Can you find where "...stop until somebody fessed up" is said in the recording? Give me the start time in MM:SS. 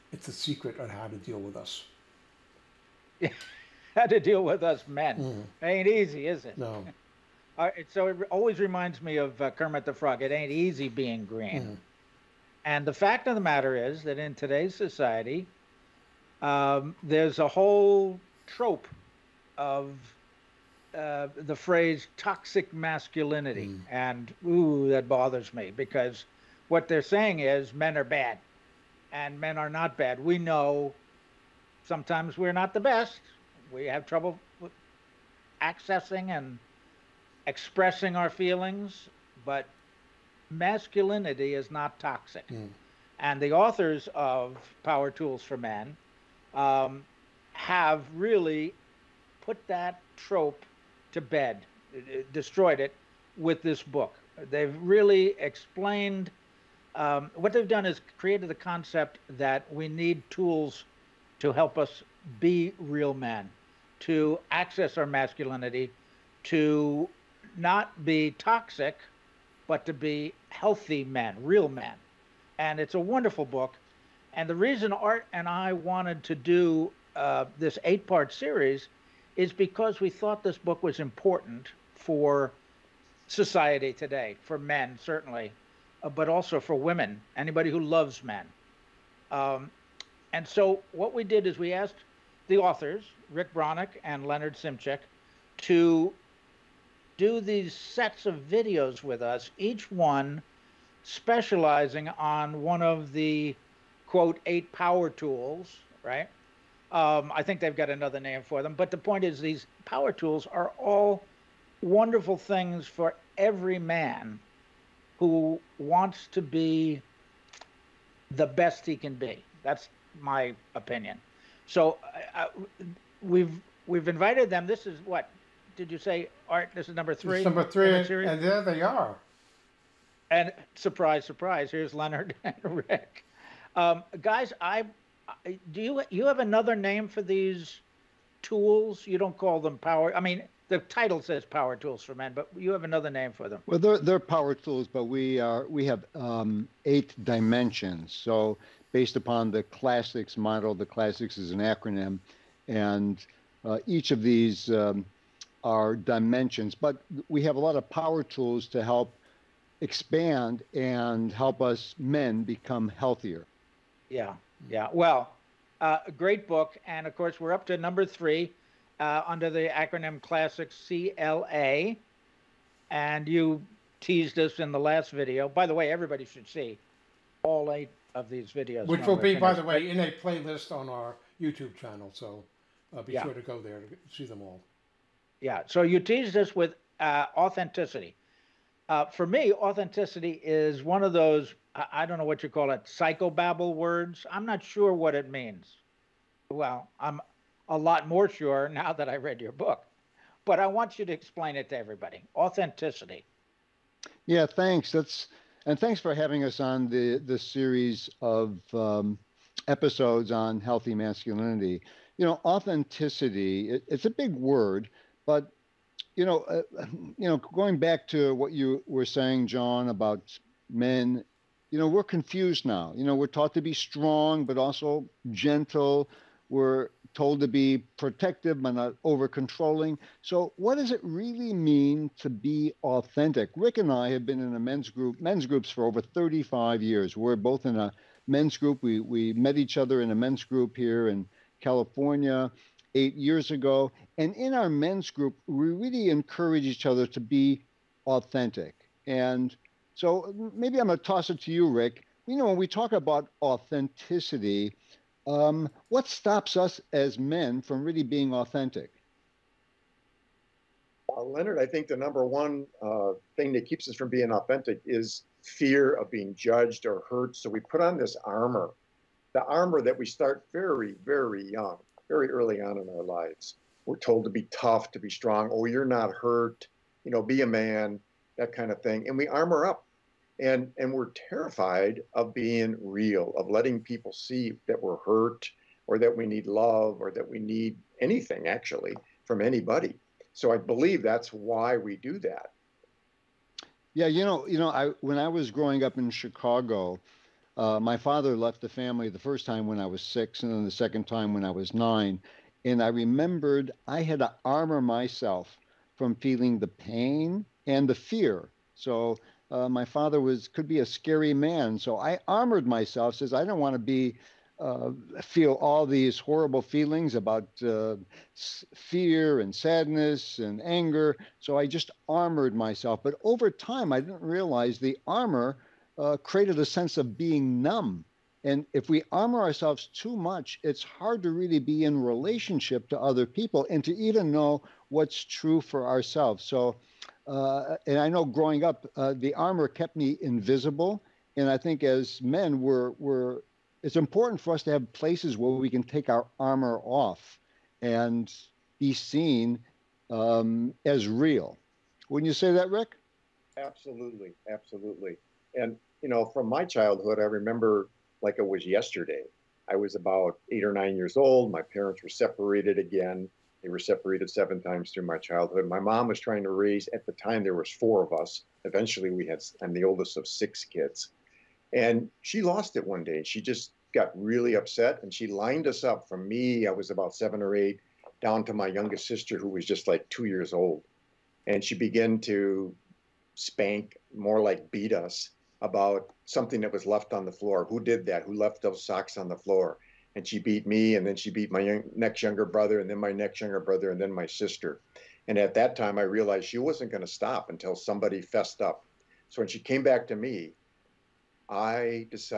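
06:37.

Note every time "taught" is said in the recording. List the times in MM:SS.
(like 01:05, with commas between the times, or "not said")
03:43.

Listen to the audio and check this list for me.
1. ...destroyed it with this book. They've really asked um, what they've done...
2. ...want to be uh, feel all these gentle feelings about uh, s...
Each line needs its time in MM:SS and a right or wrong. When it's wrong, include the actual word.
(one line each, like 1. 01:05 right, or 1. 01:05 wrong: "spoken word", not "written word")
1. 00:52 wrong: "explained", not "asked"
2. 05:13 wrong: "horrible", not "gentle".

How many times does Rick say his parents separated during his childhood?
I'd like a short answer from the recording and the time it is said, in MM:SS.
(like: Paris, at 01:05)
7, at 06:04.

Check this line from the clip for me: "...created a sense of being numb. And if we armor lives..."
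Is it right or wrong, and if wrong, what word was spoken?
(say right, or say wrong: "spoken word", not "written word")
wrong: "ourselves", not "lives".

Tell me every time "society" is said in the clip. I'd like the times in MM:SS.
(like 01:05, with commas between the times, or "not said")
00:14, 01:23.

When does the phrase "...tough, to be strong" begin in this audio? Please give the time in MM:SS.
04:34.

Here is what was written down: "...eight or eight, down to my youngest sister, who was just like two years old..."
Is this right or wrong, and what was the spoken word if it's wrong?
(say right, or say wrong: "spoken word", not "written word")
wrong: "seven", not "eight".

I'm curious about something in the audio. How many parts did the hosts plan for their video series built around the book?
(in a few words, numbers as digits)
8.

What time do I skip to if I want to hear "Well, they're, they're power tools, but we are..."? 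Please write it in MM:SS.
02:23.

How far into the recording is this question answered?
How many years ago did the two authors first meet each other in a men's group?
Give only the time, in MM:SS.
04:02.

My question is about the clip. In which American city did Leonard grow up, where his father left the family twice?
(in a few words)
Chicago.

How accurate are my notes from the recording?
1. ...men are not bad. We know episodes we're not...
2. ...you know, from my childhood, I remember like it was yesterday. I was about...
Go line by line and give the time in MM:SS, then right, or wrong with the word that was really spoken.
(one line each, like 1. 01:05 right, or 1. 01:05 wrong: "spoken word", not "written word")
1. 00:29 wrong: "sometimes", not "episodes"
2. 05:56 right.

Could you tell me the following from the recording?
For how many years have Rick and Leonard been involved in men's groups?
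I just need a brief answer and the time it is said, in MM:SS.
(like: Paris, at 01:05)
35, at 03:56.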